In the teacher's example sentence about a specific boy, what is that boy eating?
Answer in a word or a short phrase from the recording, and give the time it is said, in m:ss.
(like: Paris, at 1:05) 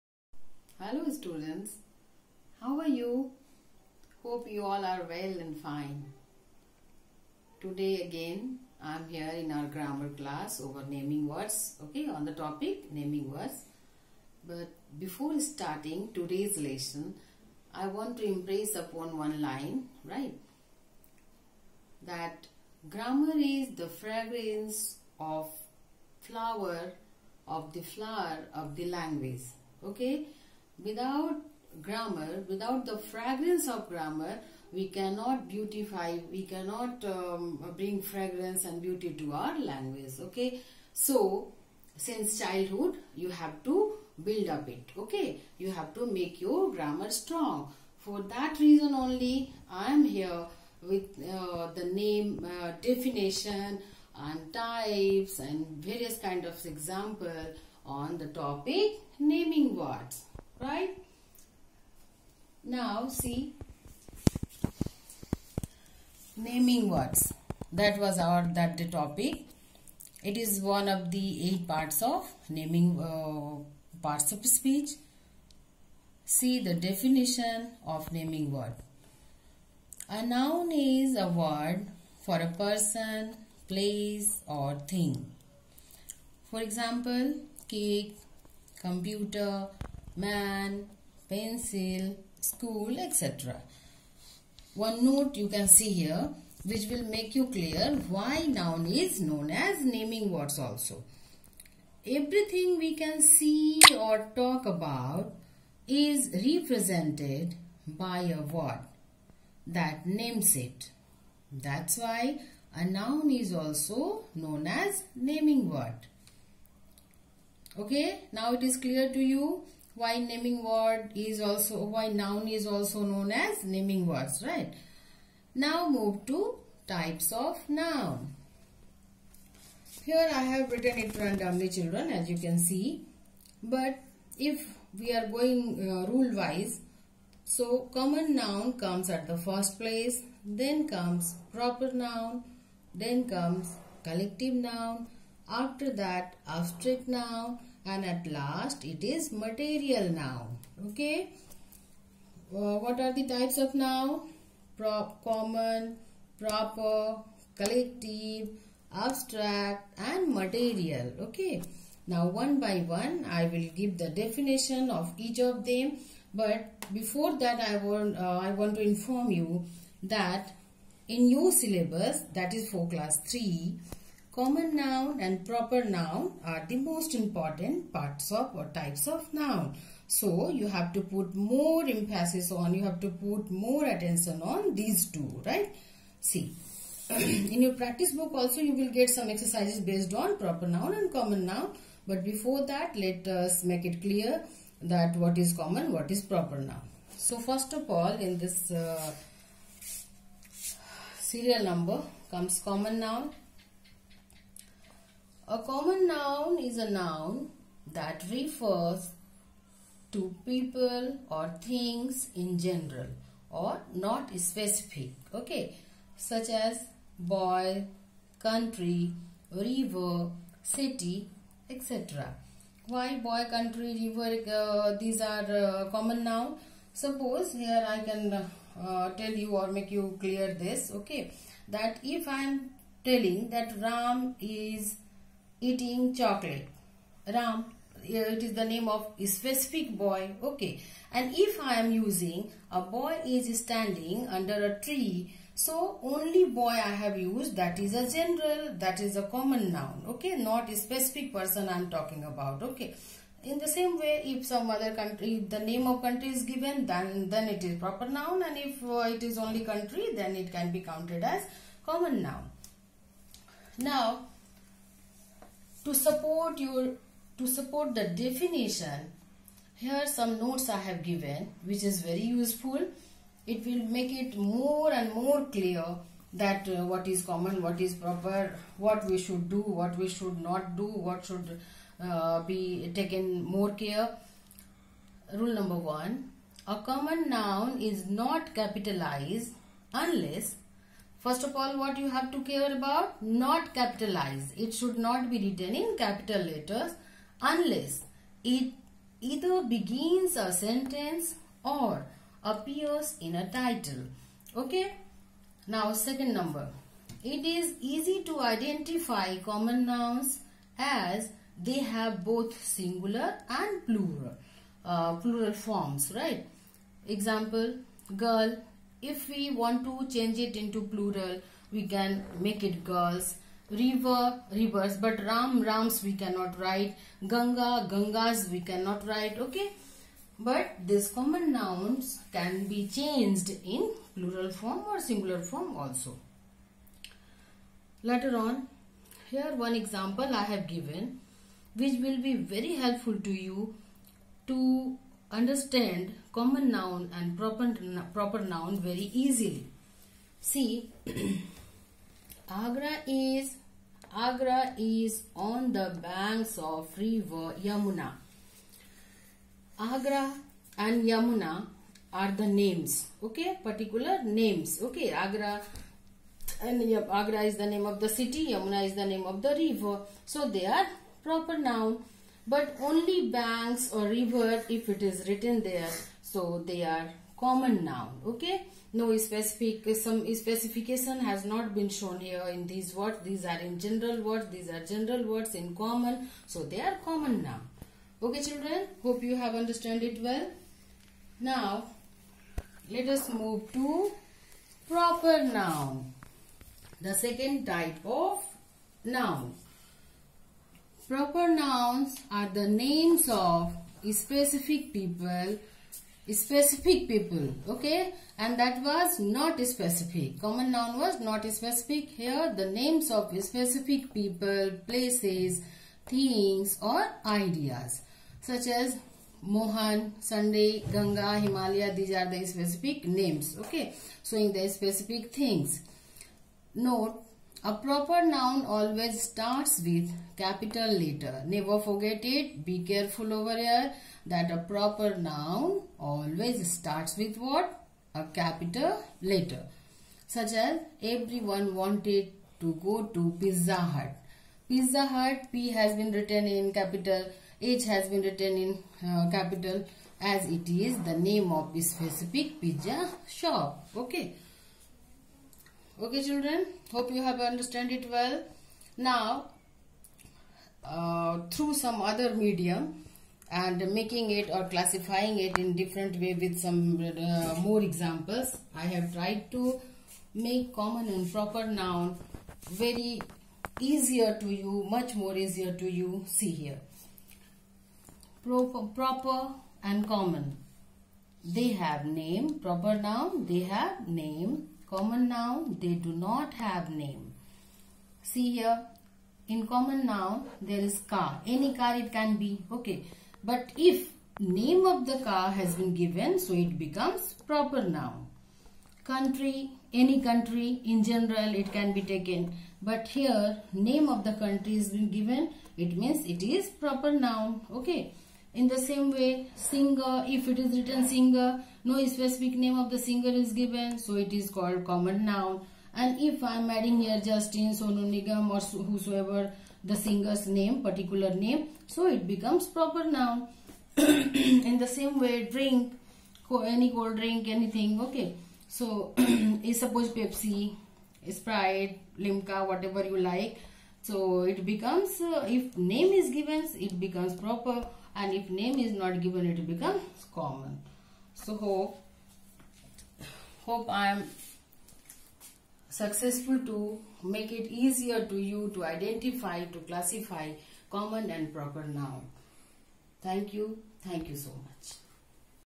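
Chocolate, at 3:56.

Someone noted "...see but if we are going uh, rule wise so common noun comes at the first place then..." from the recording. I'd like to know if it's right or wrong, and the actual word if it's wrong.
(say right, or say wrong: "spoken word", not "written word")
right.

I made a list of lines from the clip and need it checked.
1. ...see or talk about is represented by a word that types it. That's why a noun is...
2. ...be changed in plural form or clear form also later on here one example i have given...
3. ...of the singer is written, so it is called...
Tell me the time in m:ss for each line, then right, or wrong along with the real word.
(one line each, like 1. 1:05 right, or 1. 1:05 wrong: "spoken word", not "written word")
1. 1:43 wrong: "names", not "types"
2. 5:32 wrong: "singular", not "clear"
3. 8:32 wrong: "given", not "written".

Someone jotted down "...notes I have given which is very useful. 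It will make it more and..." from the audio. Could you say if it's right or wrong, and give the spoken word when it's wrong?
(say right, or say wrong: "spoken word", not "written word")
right.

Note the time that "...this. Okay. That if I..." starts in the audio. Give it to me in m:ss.
3:50.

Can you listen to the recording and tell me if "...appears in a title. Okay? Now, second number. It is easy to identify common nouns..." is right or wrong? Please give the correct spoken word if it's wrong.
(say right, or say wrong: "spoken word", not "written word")
right.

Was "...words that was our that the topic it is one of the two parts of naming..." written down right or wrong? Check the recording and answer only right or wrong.
wrong.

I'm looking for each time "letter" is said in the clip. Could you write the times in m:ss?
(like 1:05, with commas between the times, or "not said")
4:56, 7:10, 7:19.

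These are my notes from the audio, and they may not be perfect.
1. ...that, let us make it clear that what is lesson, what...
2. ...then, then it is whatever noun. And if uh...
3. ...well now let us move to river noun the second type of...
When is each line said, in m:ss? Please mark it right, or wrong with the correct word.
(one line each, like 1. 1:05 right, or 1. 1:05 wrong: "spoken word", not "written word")
1. 3:12 wrong: "common", not "lesson"
2. 4:16 wrong: "proper", not "whatever"
3. 6:30 wrong: "proper", not "river".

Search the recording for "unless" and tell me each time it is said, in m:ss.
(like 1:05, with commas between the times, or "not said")
4:49, 4:57.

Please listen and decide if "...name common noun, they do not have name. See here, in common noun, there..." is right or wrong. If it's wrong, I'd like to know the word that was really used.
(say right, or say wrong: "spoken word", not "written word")
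right.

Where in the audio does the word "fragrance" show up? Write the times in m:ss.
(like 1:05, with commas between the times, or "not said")
0:23, 0:32, 0:38.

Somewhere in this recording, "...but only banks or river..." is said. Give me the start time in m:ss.
6:12.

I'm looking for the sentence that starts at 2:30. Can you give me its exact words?
okay uh, what are the types of noun?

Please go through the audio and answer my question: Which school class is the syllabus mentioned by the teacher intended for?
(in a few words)
Class 3.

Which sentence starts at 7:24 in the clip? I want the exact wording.
Pizza Hut P has been written in capital.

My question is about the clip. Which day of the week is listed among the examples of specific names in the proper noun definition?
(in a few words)
Sunday.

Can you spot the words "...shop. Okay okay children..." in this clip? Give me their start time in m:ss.
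7:33.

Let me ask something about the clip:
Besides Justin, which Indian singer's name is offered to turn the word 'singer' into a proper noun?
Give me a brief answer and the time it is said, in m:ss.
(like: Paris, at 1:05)
Sonu Nigam, at 8:37.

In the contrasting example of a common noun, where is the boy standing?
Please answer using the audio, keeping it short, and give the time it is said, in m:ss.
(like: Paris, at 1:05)
Under a tree, at 4:04.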